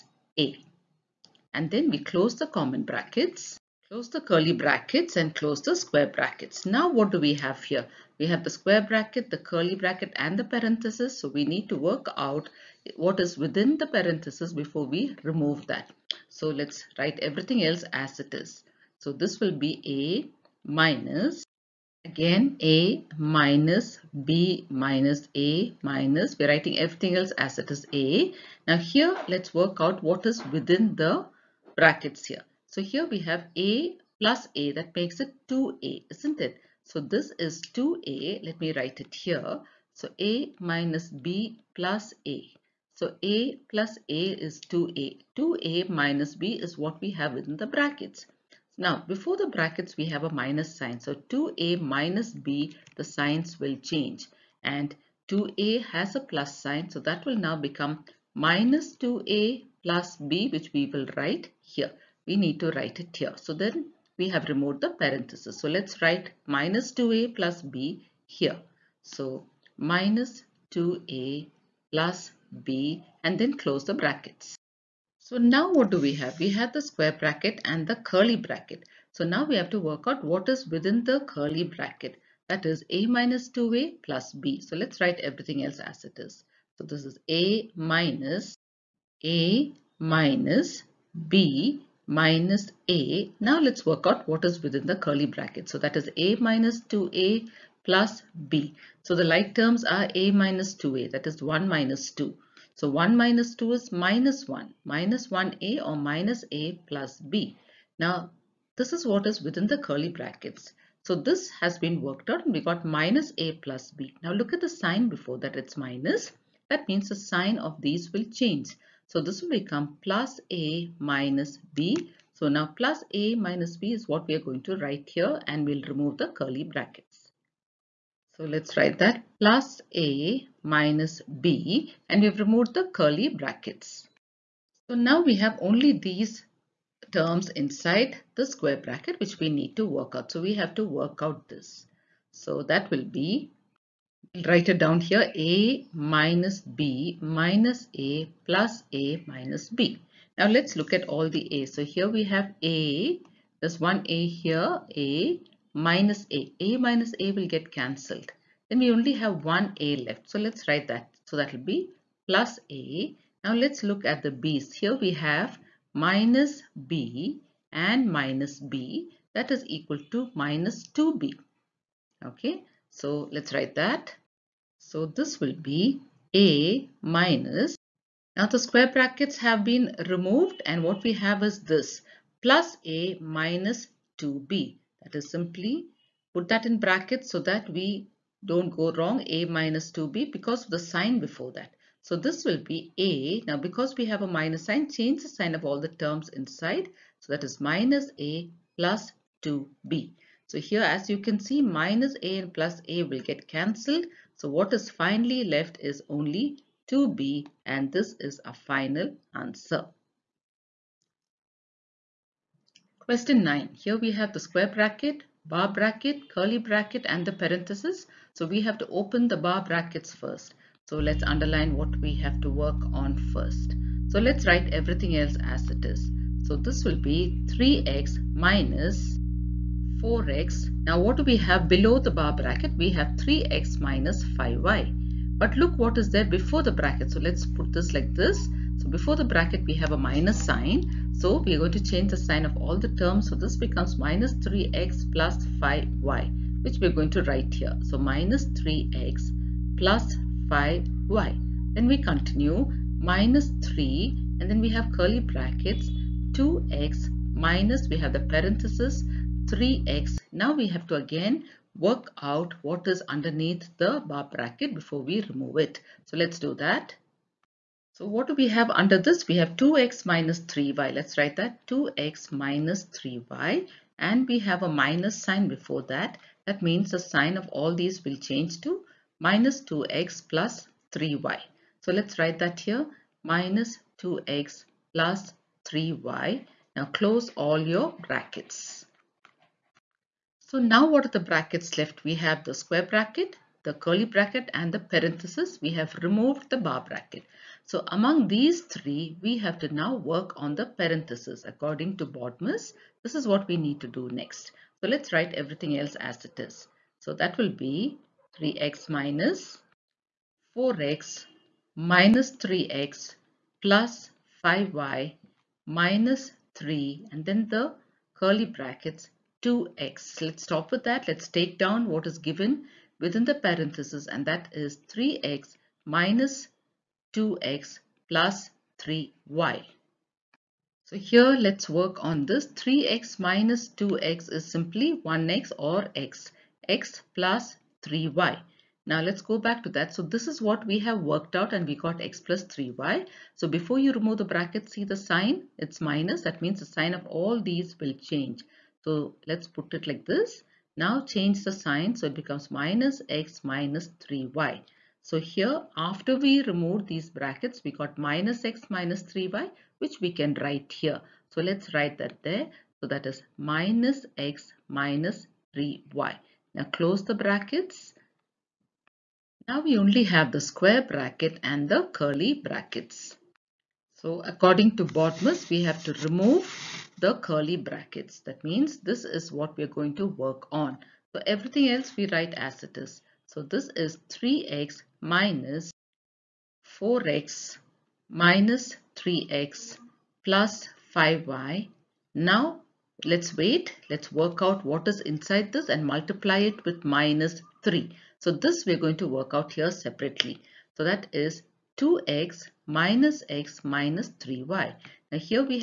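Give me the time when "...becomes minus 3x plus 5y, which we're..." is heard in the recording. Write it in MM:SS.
04:03.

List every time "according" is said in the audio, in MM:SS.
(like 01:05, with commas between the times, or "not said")
05:01, 06:14.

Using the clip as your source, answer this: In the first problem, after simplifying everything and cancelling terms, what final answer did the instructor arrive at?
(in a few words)
2b.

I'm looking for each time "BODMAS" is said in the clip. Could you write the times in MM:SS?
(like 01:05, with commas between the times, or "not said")
05:02, 06:14.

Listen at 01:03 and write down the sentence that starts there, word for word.
So then we have removed the parenthesis.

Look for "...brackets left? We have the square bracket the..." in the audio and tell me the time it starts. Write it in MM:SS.
04:51.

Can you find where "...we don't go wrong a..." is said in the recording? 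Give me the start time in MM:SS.
03:07.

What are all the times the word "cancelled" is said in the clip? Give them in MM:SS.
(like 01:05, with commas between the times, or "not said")
02:37, 03:23.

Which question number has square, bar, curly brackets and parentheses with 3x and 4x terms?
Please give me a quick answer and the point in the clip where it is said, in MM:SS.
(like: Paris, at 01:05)
9, at 03:33.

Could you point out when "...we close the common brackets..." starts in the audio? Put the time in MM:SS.
00:01.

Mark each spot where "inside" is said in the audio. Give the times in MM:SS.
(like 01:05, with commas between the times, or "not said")
02:17, 03:16, 06:35.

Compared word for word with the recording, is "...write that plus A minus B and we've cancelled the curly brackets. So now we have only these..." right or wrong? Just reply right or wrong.
wrong.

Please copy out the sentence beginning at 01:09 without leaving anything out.
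So minus 2a plus b and then close the brackets.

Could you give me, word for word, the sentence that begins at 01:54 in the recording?
Now look at the sign before that it's minus.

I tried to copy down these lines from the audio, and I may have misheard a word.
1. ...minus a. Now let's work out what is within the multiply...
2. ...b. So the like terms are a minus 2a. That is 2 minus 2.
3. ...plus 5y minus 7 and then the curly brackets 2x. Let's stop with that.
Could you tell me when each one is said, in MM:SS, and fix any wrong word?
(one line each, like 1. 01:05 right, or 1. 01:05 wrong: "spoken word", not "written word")
1. 01:32 wrong: "curly", not "multiply"
2. 01:38 wrong: "1", not "2"
3. 05:13 wrong: "3", not "7".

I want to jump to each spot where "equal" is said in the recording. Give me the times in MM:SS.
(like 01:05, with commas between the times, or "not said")
02:49.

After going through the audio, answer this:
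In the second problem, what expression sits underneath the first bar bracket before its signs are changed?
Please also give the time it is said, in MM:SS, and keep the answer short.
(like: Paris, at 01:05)
3x - 5y, at 03:53.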